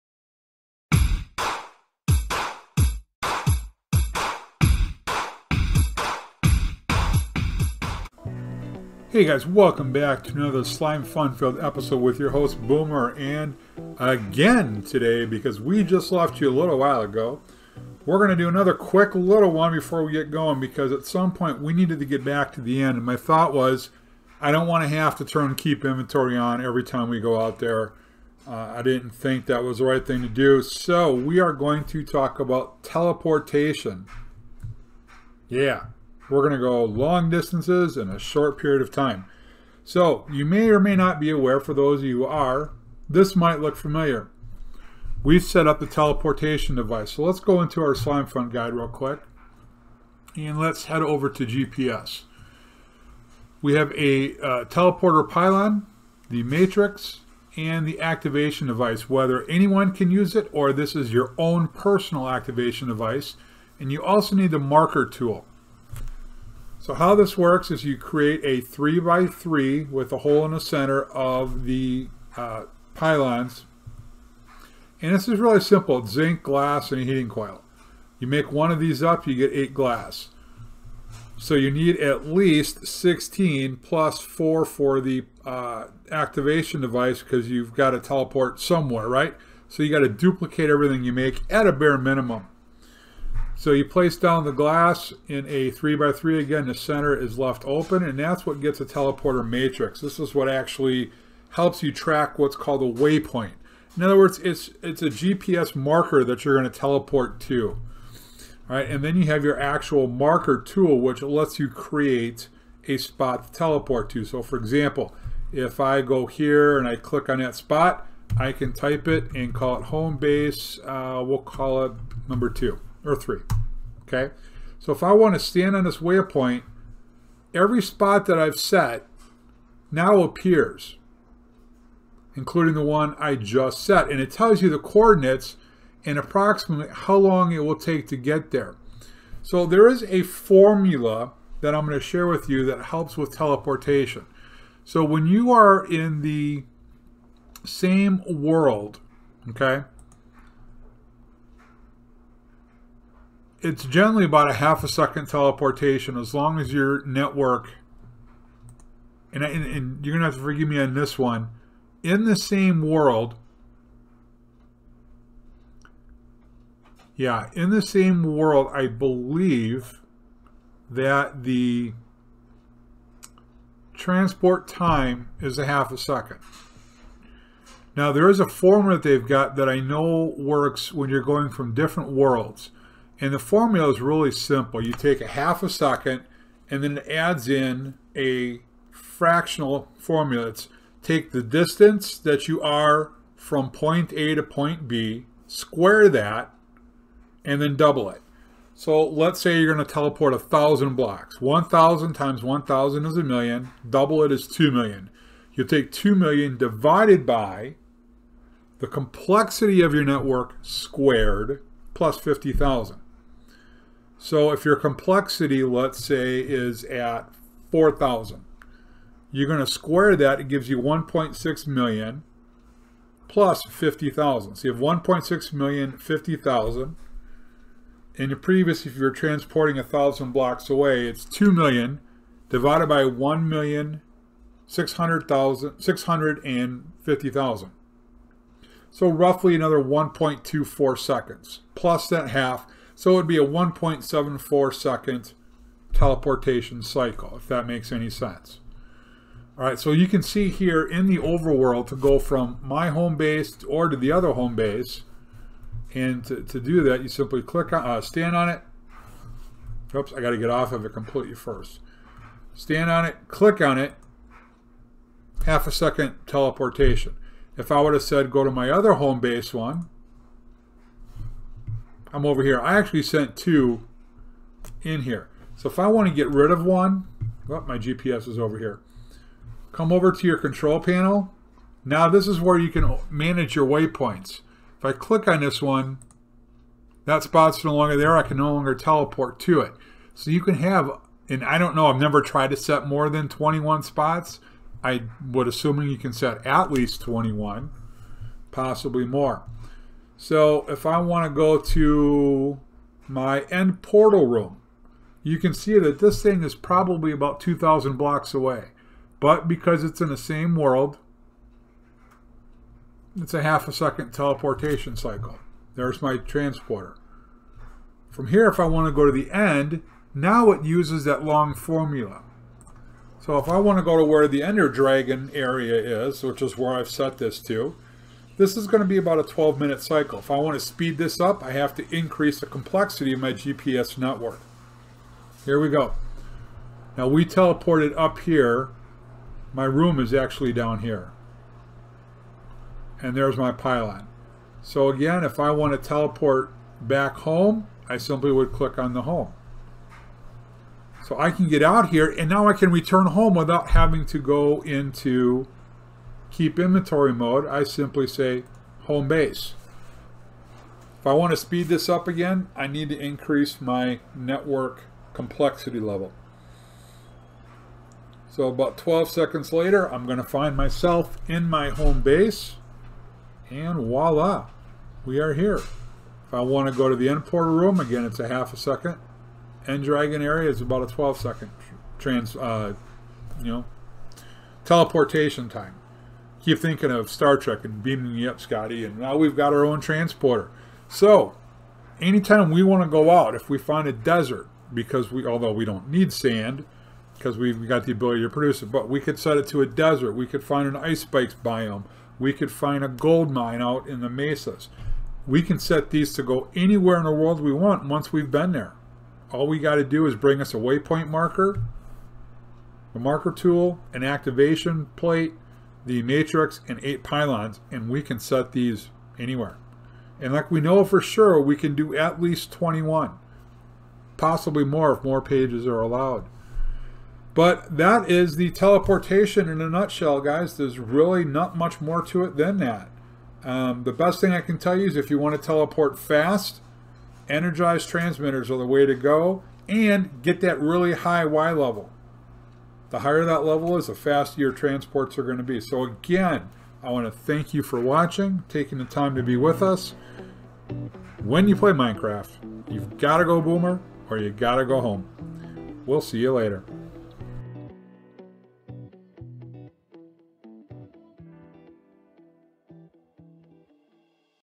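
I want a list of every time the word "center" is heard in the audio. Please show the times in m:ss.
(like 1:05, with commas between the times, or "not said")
1:10, 1:36.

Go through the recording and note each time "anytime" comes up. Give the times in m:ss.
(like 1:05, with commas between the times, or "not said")
6:31.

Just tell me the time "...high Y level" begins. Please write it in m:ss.
7:20.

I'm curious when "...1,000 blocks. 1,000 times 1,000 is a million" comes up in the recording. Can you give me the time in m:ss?
3:20.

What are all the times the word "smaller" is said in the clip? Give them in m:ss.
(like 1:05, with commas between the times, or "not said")
not said.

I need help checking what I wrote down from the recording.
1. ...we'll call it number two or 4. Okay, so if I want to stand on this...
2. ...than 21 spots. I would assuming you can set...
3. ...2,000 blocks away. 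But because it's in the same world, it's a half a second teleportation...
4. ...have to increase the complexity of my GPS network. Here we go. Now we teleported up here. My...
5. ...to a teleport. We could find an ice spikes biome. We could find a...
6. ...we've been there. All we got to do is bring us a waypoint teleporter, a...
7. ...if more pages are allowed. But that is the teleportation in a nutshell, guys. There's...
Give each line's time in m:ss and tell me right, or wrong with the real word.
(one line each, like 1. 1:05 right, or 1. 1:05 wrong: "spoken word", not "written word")
1. 2:01 wrong: "3", not "4"
2. 4:53 right
3. 5:07 right
4. 5:31 right
5. 6:39 wrong: "desert", not "teleport"
6. 6:48 wrong: "marker", not "teleporter"
7. 7:04 right.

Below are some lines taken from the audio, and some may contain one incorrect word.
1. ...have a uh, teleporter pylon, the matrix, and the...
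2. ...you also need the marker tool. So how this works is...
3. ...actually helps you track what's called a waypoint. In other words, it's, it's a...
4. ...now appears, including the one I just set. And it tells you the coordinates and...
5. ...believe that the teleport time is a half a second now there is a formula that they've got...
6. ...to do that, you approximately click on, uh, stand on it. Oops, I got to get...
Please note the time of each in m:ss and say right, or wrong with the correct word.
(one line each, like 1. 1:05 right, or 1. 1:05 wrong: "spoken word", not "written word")
1. 0:53 right
2. 1:03 right
3. 1:40 right
4. 2:09 right
5. 2:48 wrong: "transport", not "teleport"
6. 4:16 wrong: "simply", not "approximately".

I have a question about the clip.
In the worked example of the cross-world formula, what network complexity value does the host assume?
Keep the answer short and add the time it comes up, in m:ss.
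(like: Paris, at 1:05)
4,000, at 3:37.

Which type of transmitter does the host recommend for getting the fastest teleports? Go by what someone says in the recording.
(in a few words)
energized transmitters.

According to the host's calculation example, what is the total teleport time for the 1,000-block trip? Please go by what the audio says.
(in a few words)
1.74 seconds.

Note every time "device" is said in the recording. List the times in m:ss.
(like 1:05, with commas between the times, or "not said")
0:46, 0:58, 1:02, 1:26.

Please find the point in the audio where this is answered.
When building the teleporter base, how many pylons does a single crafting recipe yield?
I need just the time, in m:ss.
1:19.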